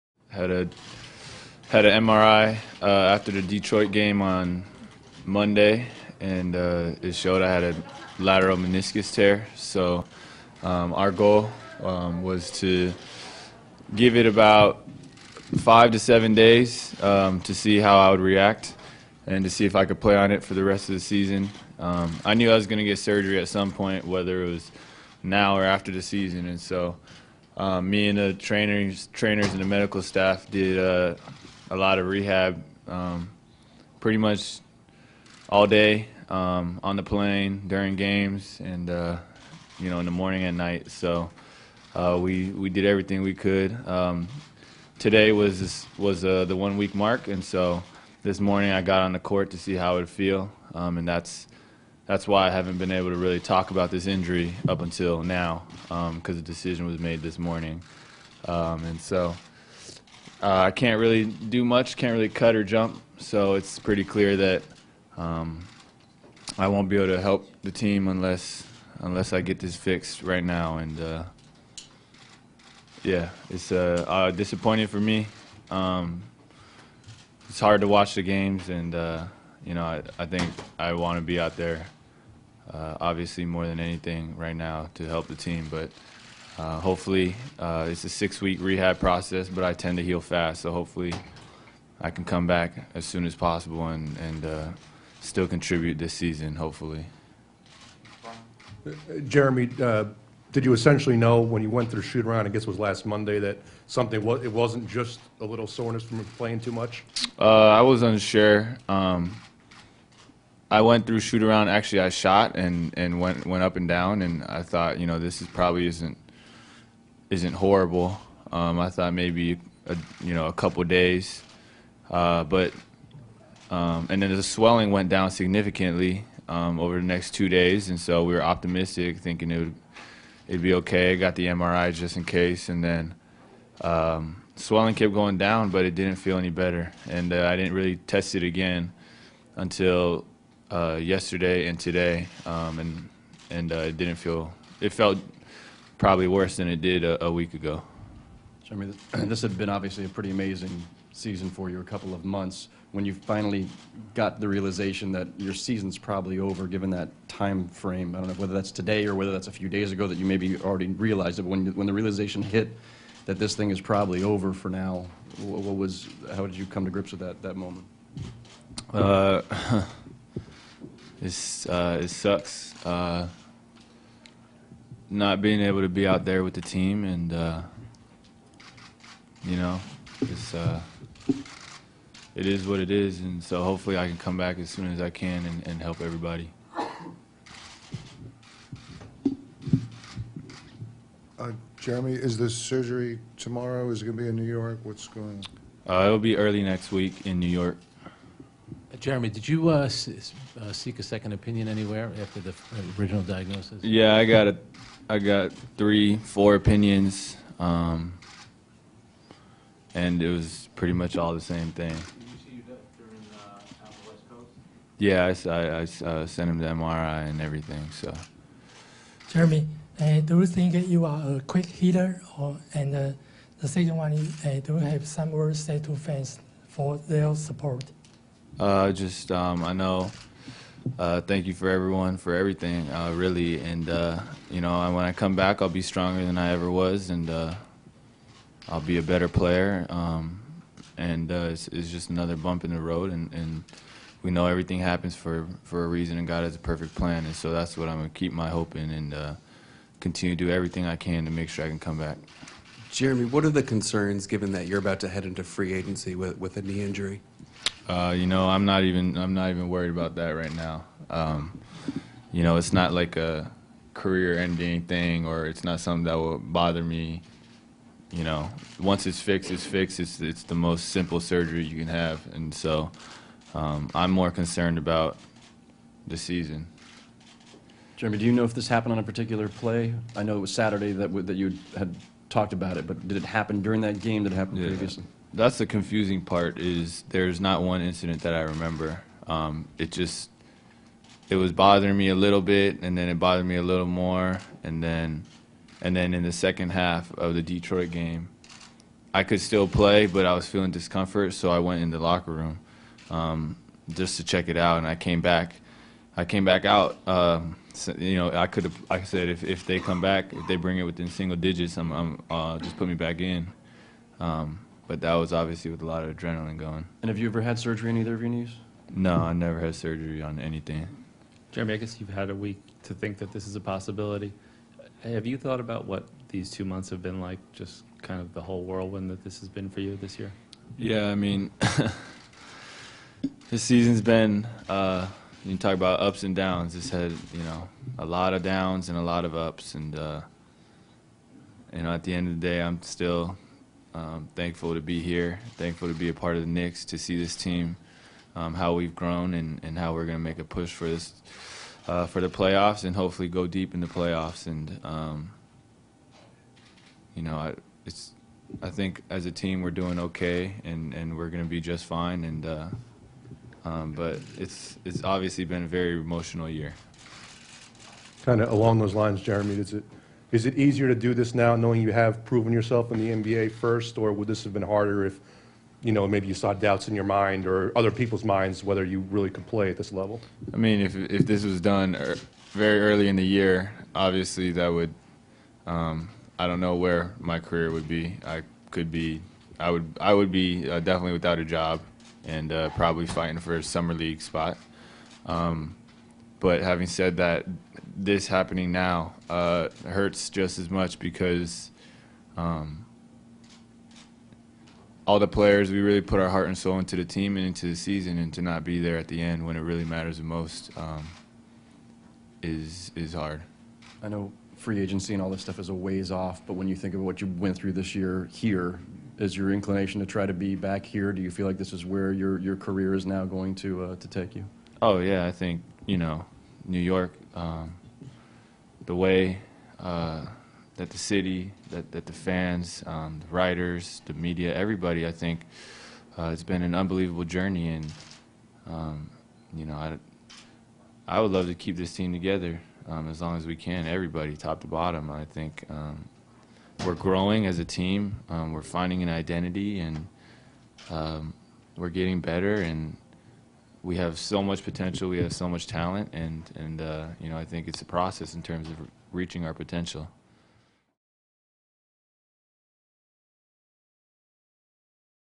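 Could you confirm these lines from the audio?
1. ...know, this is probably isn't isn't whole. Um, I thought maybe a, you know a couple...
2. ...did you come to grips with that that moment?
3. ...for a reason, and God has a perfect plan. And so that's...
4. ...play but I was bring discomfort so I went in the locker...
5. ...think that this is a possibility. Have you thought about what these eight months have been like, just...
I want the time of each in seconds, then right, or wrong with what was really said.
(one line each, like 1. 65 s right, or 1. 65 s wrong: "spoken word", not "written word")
1. 115 s wrong: "horrible", not "whole"
2. 166 s right
3. 245 s right
4. 299 s wrong: "feeling", not "bring"
5. 322 s wrong: "two", not "eight".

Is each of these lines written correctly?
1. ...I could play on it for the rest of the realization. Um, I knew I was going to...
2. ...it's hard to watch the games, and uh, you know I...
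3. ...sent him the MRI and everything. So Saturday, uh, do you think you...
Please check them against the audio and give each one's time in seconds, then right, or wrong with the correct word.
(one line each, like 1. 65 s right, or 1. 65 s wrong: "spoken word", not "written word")
1. 19 s wrong: "season", not "realization"
2. 77 s right
3. 216 s wrong: "Jeremy", not "Saturday".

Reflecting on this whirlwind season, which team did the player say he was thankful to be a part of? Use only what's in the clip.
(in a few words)
Knicks.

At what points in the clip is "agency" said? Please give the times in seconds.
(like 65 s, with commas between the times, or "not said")
255 s, 414 s.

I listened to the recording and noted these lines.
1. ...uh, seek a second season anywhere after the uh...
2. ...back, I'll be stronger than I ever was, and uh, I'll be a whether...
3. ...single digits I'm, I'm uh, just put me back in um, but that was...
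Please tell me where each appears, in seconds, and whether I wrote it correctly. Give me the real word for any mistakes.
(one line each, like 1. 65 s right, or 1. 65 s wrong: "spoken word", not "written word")
1. 200 s wrong: "opinion", not "season"
2. 235 s wrong: "better", not "whether"
3. 311 s right.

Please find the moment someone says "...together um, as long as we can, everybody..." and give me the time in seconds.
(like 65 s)
442 s.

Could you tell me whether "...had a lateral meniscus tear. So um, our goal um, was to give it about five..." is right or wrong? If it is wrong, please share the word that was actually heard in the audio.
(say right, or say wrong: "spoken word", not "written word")
right.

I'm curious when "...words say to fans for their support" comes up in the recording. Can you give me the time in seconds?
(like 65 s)
225 s.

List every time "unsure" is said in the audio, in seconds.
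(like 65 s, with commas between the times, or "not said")
108 s.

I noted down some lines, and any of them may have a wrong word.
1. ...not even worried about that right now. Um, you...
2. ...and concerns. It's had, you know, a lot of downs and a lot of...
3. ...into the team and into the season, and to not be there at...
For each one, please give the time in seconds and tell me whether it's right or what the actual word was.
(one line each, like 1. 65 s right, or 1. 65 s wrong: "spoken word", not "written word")
1. 259 s right
2. 336 s wrong: "downs", not "concerns"
3. 406 s right.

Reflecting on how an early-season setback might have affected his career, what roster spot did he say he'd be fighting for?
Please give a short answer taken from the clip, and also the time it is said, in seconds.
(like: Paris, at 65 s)
Summer league spot, at 393 s.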